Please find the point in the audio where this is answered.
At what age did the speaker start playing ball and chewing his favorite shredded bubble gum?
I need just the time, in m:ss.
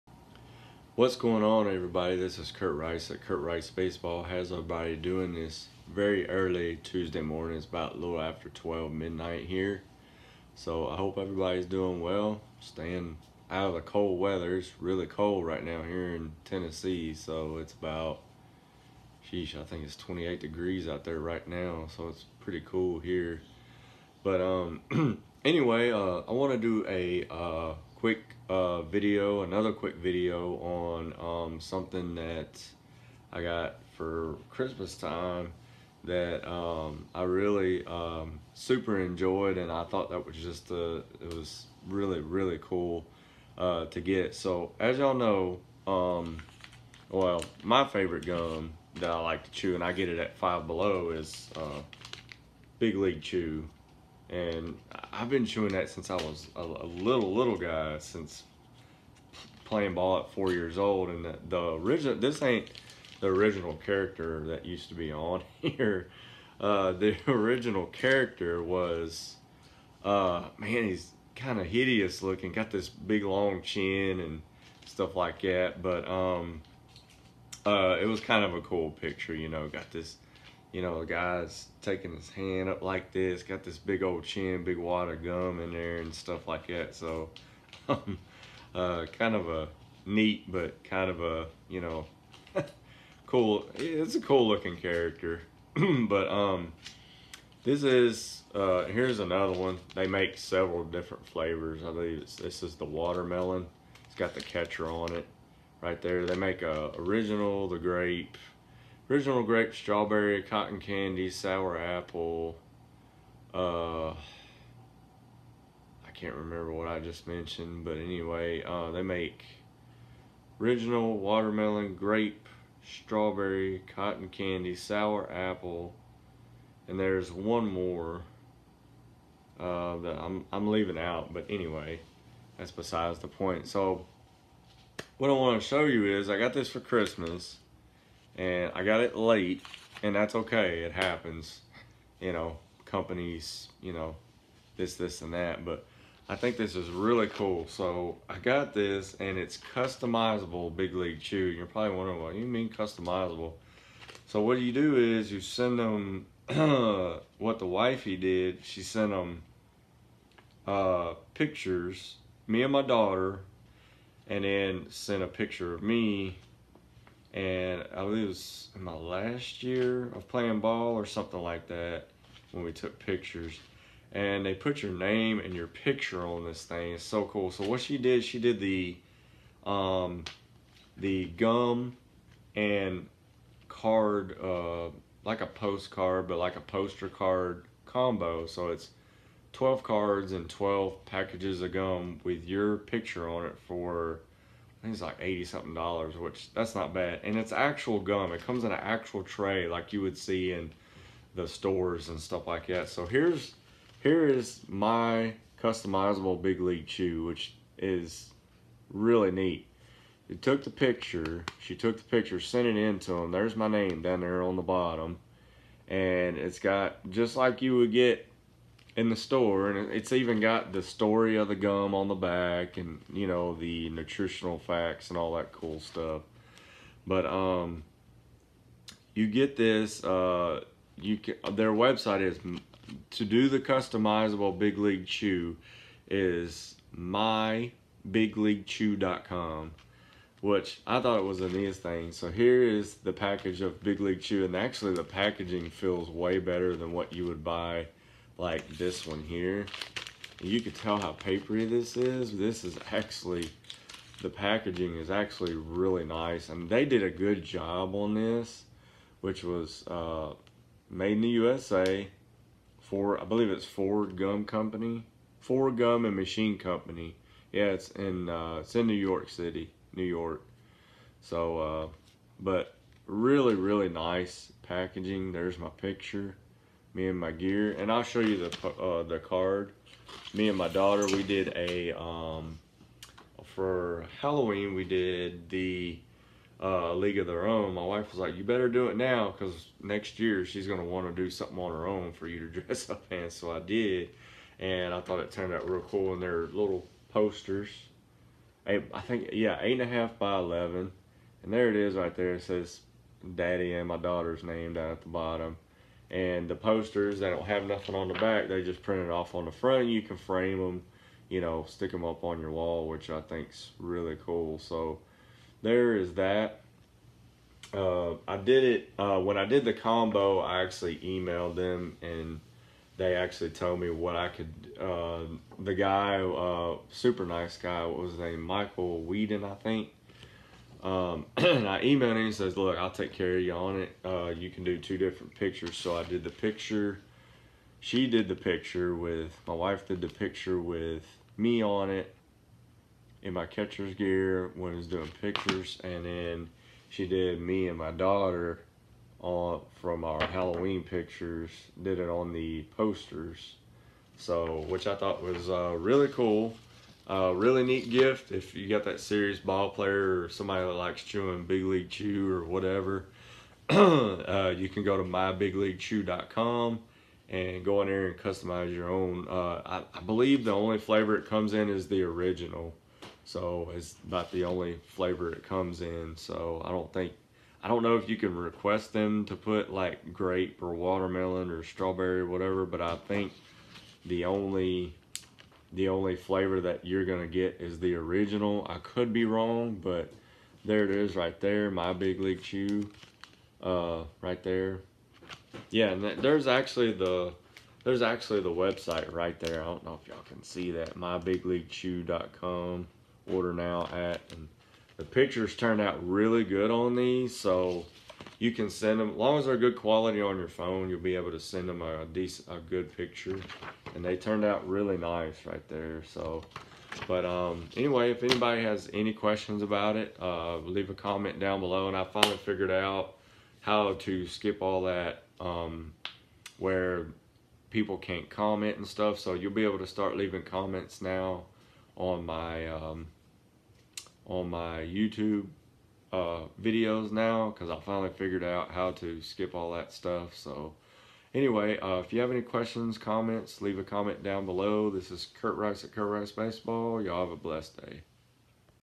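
1:00.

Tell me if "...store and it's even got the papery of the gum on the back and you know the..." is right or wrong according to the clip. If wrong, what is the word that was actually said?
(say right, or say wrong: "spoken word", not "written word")
wrong: "story", not "papery".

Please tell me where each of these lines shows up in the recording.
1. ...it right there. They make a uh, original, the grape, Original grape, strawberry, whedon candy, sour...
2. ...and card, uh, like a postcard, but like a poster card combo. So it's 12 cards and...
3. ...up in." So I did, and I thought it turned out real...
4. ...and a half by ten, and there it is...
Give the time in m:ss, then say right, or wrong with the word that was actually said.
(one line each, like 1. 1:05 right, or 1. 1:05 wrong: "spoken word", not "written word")
1. 1:45 wrong: "cotton", not "whedon"
2. 3:02 right
3. 4:52 right
4. 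4:59 wrong: "eleven", not "ten".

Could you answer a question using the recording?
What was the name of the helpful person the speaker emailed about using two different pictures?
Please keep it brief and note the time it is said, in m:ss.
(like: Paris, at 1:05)
Michael Whedon, at 5:28.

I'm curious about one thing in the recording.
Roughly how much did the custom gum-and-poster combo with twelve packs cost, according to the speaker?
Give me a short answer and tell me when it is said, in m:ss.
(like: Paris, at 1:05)
80 something dollars, at 3:15.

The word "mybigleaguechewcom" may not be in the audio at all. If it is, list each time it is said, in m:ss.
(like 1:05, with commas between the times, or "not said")
3:56, 6:05, 6:40.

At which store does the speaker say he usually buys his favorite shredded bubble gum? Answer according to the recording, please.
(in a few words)
Five Below.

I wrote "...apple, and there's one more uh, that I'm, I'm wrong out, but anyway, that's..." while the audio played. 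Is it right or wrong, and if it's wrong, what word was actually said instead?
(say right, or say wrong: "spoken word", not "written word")
wrong: "leaving", not "wrong".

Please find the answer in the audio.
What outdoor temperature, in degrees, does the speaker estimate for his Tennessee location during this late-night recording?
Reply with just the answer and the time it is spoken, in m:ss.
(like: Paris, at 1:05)
28, at 0:19.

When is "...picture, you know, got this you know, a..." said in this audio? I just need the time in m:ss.
1:18.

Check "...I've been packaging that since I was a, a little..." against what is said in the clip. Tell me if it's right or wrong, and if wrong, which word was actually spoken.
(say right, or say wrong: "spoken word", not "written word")
wrong: "chewing", not "packaging".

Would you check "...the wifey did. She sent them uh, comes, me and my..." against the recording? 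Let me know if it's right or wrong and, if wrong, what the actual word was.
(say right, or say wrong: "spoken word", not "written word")
wrong: "pictures", not "comes".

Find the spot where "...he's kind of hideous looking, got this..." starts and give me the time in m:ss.
1:10.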